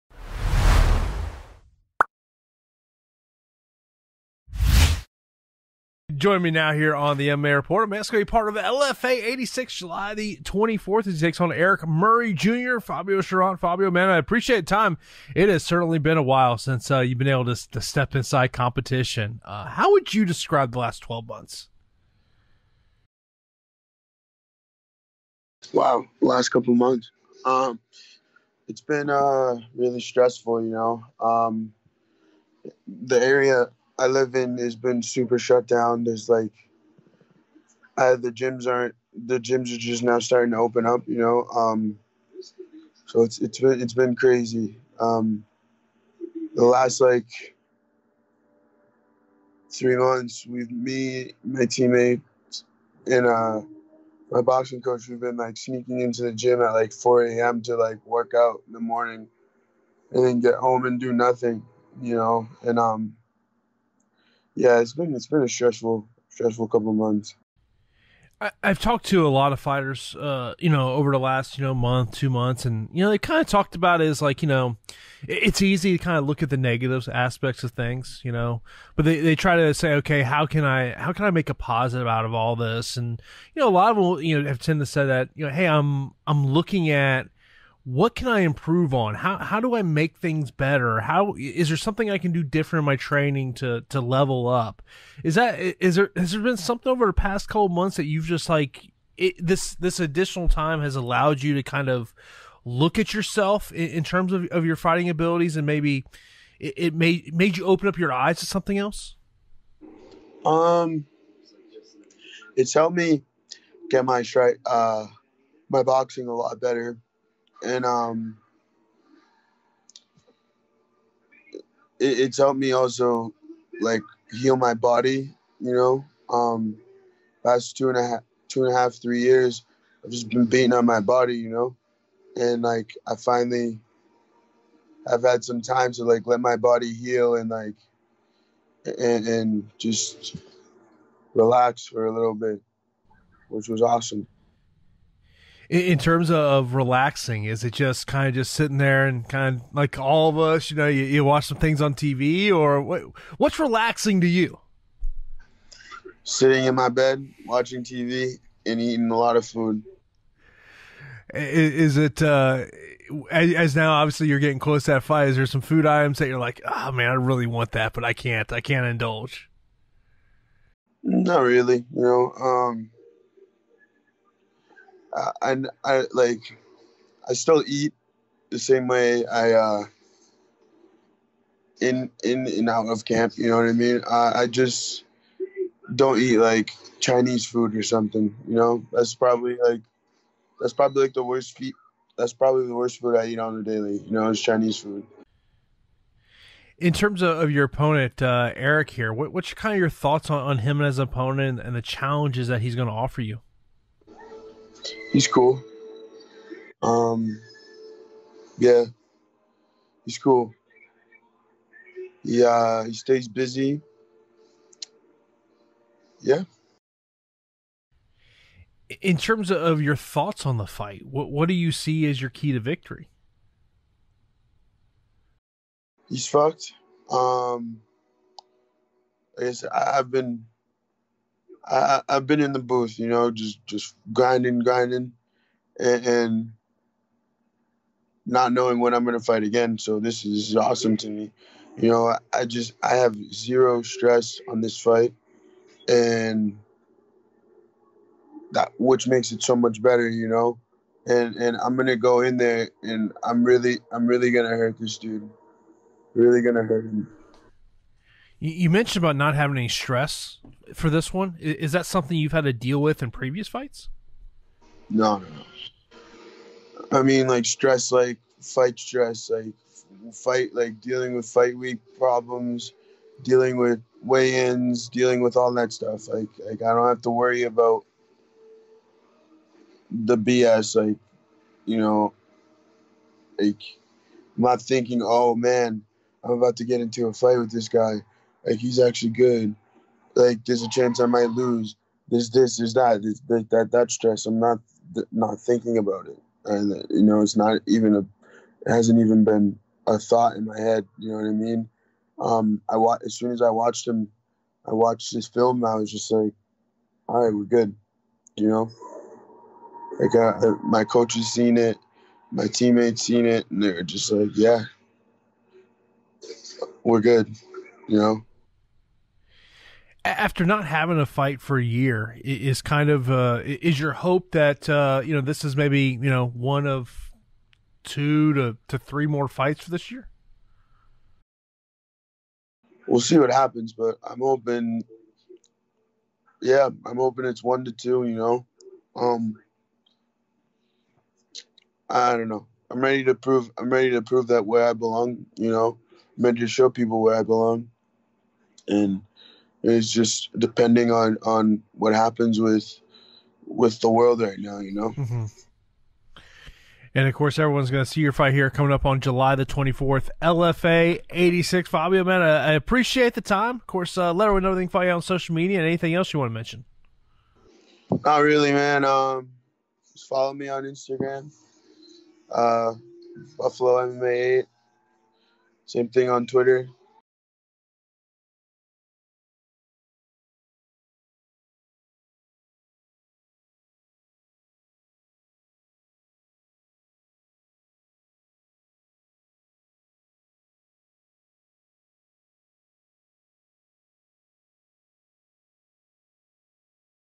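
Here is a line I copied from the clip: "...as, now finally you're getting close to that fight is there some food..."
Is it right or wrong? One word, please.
wrong.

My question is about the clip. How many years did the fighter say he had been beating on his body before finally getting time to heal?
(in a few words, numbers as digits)
3 years.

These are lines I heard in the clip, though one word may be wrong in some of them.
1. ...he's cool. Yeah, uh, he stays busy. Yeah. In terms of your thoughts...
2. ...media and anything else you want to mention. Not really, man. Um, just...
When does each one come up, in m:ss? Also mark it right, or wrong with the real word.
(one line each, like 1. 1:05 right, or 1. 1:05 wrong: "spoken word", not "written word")
1. 3:30 right
2. 6:05 right.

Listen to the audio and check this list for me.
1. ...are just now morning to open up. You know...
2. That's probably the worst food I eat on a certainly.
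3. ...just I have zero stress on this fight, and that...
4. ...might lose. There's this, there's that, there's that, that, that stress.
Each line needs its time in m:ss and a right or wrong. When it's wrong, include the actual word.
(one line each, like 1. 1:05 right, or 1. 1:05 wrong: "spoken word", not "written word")
1. 0:39 wrong: "starting", not "morning"
2. 3:12 wrong: "daily", not "certainly"
3. 4:02 right
4. 4:51 right.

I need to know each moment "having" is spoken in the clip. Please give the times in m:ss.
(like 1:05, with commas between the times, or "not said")
4:19, 5:20.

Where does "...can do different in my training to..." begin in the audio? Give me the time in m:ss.
1:32.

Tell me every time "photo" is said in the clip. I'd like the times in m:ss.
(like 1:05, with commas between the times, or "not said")
not said.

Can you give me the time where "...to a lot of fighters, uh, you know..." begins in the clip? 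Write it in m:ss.
1:09.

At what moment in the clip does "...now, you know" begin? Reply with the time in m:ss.
5:54.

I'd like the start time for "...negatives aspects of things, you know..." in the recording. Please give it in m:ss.
1:16.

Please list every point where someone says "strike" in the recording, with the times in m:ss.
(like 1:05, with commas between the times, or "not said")
1:54.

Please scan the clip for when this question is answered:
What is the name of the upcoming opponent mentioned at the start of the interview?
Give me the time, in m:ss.
0:11.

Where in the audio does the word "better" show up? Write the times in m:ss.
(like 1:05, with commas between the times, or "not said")
1:30, 1:56, 4:09.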